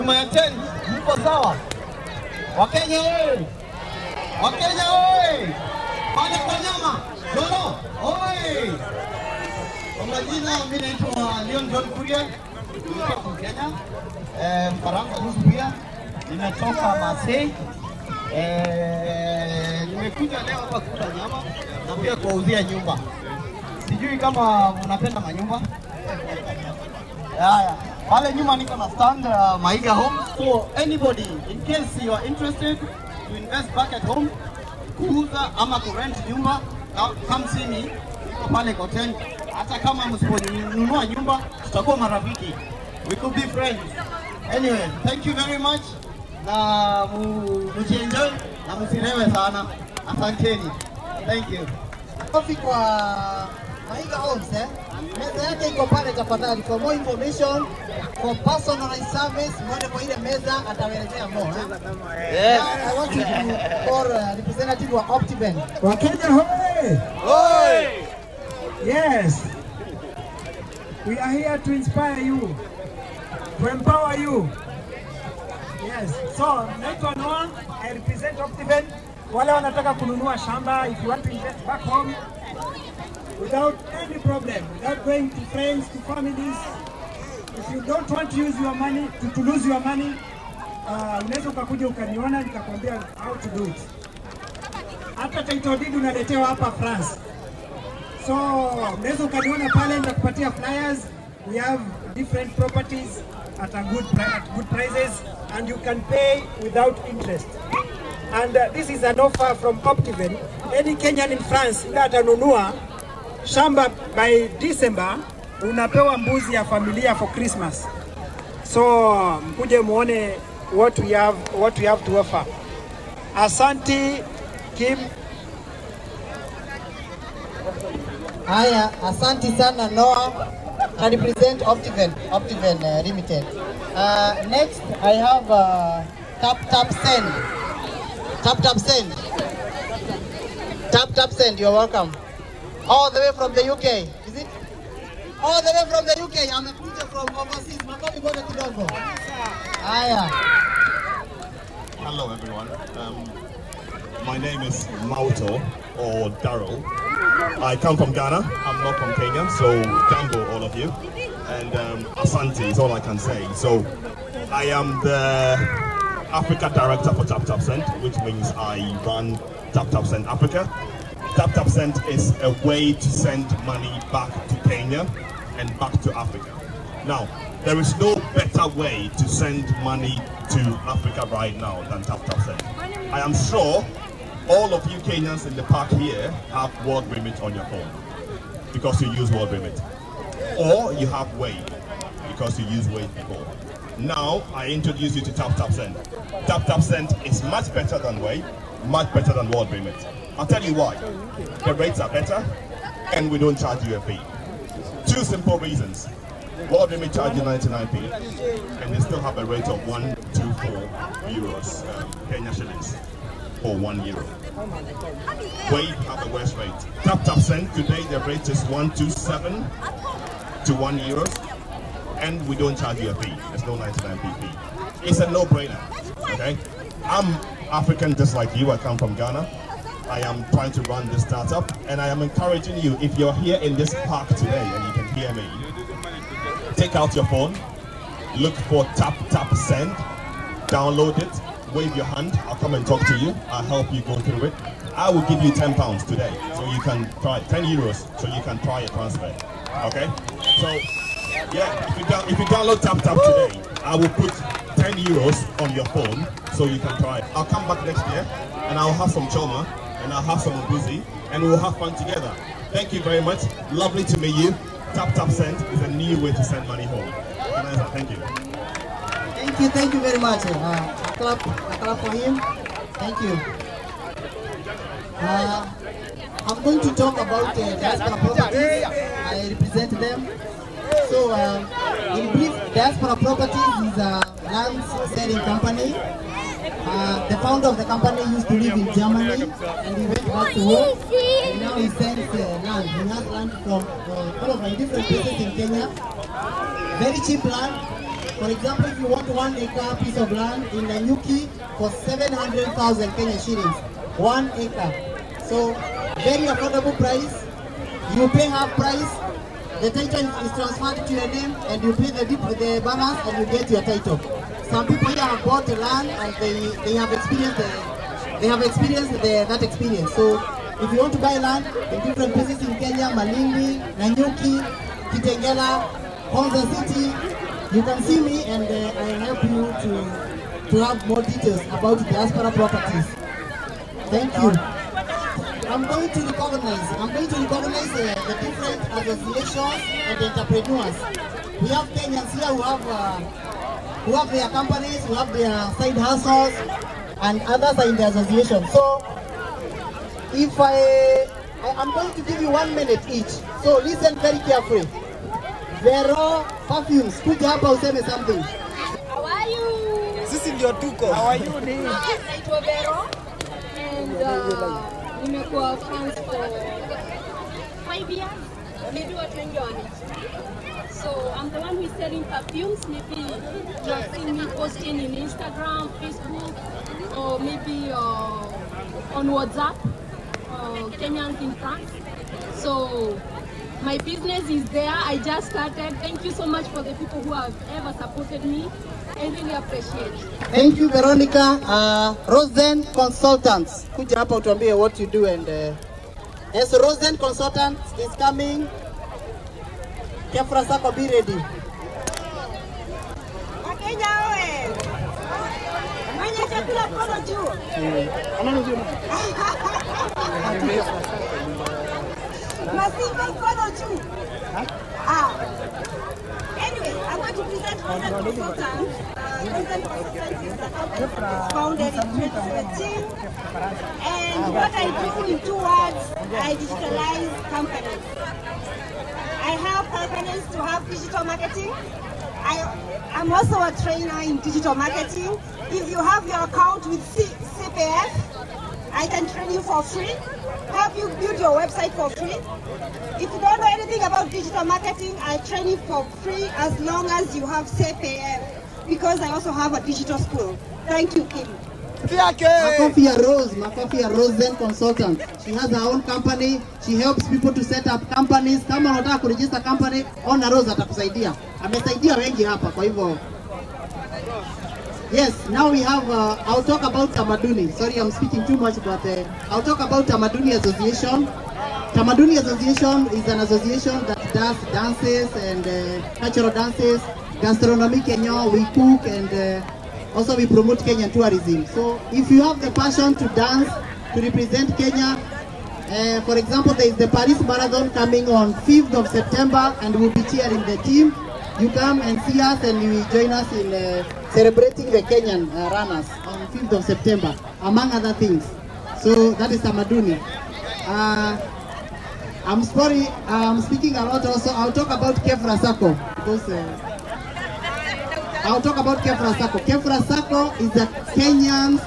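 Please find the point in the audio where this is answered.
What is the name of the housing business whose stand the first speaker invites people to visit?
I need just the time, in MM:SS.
00:29.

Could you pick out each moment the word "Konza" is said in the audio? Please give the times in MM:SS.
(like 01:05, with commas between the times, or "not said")
05:26.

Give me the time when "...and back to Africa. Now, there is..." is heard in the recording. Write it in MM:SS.
02:55.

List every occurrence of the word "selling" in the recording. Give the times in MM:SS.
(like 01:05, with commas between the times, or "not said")
04:45, 06:11.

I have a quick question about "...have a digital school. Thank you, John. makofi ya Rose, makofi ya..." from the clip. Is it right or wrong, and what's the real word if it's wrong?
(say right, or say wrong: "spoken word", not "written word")
wrong: "Kim", not "John".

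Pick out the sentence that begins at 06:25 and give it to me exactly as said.
Thank you so much for the people who have ever supported me.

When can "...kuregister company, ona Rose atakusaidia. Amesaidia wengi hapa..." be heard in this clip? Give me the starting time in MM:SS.
07:39.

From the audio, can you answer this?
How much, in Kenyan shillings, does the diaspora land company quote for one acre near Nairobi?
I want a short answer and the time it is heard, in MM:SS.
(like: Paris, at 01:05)
700,000, at 05:01.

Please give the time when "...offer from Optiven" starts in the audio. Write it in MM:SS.
01:49.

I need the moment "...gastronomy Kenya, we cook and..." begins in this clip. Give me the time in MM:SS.
07:57.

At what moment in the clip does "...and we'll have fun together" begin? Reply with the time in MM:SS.
04:21.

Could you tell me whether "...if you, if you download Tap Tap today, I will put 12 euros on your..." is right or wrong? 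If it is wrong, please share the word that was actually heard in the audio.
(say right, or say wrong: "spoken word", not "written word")
wrong: "10", not "12".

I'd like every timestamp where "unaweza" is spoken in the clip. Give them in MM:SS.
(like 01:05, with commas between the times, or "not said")
01:31, 01:38.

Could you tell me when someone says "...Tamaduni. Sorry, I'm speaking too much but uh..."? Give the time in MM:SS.
07:47.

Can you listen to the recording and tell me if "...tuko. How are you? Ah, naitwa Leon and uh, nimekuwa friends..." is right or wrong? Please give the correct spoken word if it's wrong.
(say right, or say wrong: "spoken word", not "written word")
wrong: "Vero", not "Leon".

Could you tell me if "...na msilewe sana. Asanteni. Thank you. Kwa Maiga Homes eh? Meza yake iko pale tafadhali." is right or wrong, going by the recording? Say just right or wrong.
right.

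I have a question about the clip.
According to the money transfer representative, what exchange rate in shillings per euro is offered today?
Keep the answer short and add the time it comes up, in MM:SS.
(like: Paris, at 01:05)
127, at 03:38.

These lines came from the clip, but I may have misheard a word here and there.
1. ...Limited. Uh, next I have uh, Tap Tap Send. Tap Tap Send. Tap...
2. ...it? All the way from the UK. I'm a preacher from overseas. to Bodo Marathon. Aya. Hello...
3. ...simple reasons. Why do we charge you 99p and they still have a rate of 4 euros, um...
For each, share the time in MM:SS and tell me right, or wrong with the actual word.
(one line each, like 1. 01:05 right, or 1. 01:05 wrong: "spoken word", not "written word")
1. 02:13 right
2. 02:24 wrong: "Kidogo", not "Marathon"
3. 03:25 right.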